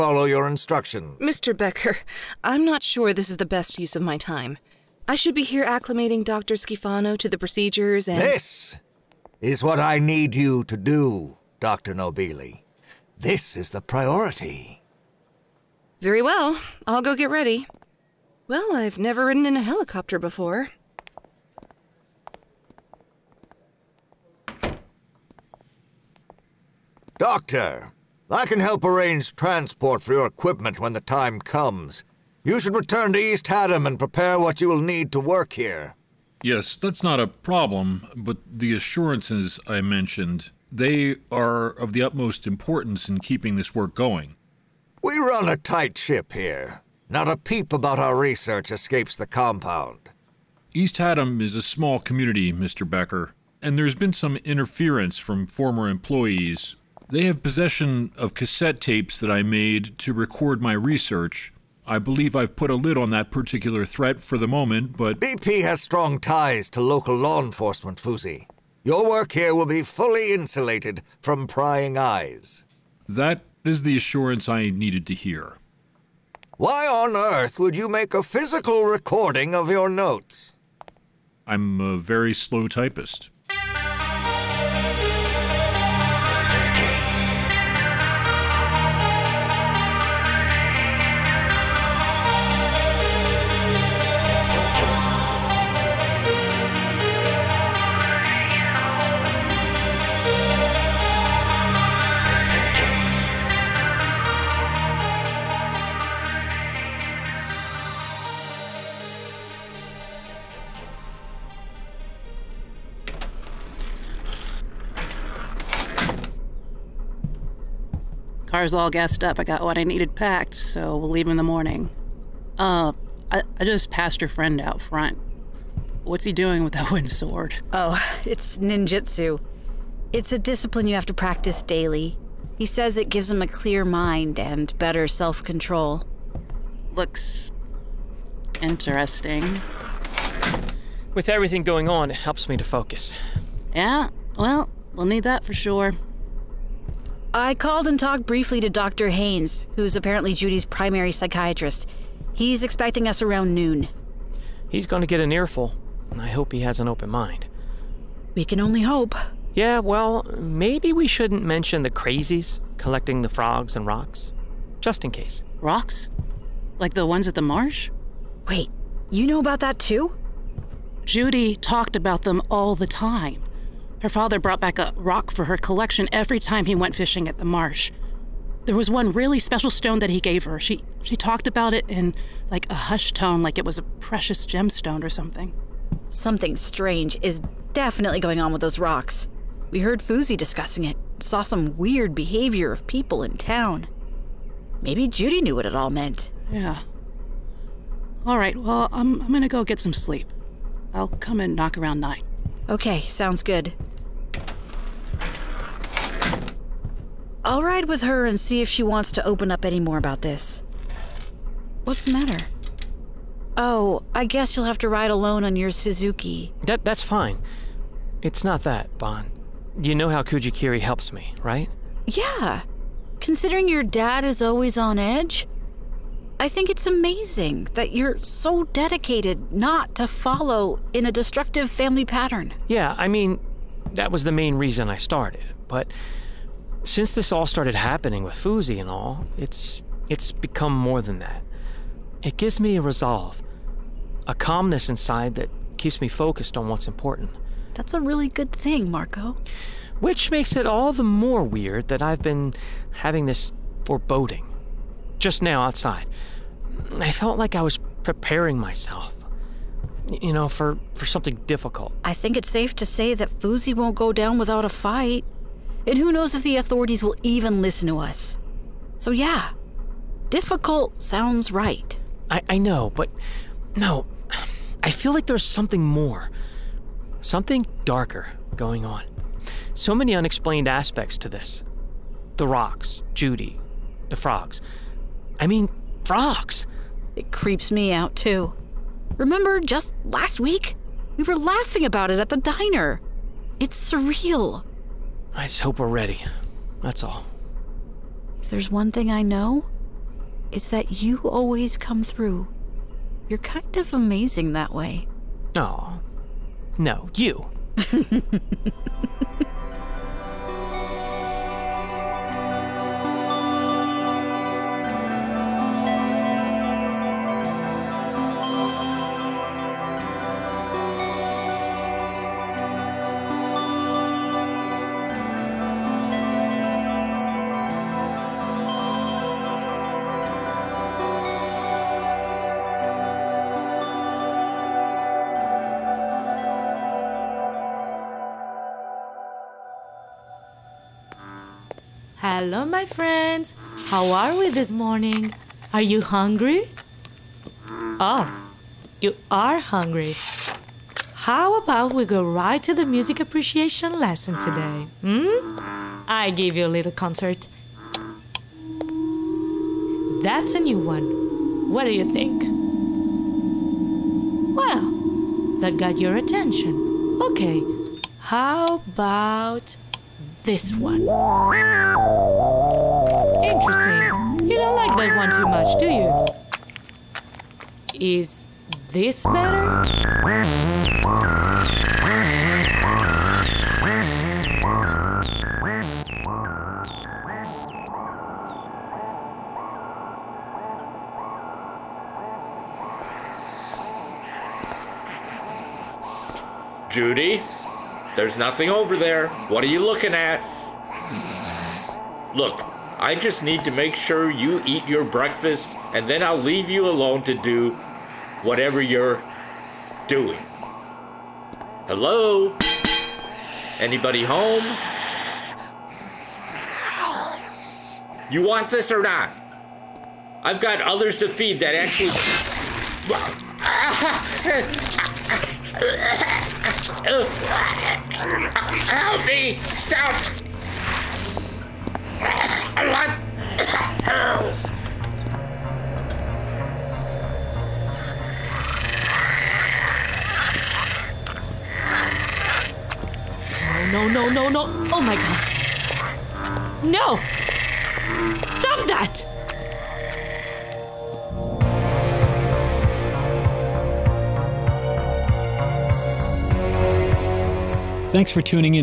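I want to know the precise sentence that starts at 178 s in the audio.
There was one really special stone that he gave her.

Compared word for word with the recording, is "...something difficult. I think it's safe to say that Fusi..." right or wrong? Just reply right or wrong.
right.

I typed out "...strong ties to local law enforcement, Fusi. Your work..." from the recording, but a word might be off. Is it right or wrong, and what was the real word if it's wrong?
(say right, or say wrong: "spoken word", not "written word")
right.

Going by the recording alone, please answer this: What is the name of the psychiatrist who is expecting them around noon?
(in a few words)
Dr. Haines.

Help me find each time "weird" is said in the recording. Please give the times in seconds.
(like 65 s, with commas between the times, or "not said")
191 s, 251 s.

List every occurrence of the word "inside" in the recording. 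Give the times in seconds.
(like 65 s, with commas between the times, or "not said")
244 s.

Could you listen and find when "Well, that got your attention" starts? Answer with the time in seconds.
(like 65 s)
364 s.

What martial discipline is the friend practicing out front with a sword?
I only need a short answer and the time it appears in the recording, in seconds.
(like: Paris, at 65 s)
Ninjutsu, at 128 s.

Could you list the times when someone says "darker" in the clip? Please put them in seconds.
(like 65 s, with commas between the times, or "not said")
277 s.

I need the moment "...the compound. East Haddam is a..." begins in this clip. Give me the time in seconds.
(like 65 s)
49 s.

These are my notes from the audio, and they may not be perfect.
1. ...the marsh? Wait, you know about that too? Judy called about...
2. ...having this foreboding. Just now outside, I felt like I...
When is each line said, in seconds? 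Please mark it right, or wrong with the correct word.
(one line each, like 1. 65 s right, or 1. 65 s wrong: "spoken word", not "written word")
1. 167 s wrong: "talked", not "called"
2. 252 s right.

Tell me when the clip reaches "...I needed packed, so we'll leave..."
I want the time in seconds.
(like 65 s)
119 s.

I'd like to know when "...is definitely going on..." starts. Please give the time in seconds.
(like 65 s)
187 s.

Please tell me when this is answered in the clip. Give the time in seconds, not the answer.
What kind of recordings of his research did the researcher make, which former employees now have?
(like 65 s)
58 s.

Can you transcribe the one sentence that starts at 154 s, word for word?
He's going to get an earful, and I hope he has an open mind.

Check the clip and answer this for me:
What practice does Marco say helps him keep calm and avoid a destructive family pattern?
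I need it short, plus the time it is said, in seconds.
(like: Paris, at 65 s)
Kujikiri, at 220 s.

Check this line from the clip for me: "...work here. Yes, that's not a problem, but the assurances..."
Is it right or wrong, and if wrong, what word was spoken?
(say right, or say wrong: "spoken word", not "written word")
right.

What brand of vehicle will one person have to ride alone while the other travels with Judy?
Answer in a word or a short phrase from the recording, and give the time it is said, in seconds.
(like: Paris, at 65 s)
Suzuki, at 215 s.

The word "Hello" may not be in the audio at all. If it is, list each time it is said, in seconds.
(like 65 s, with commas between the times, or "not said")
342 s, 411 s.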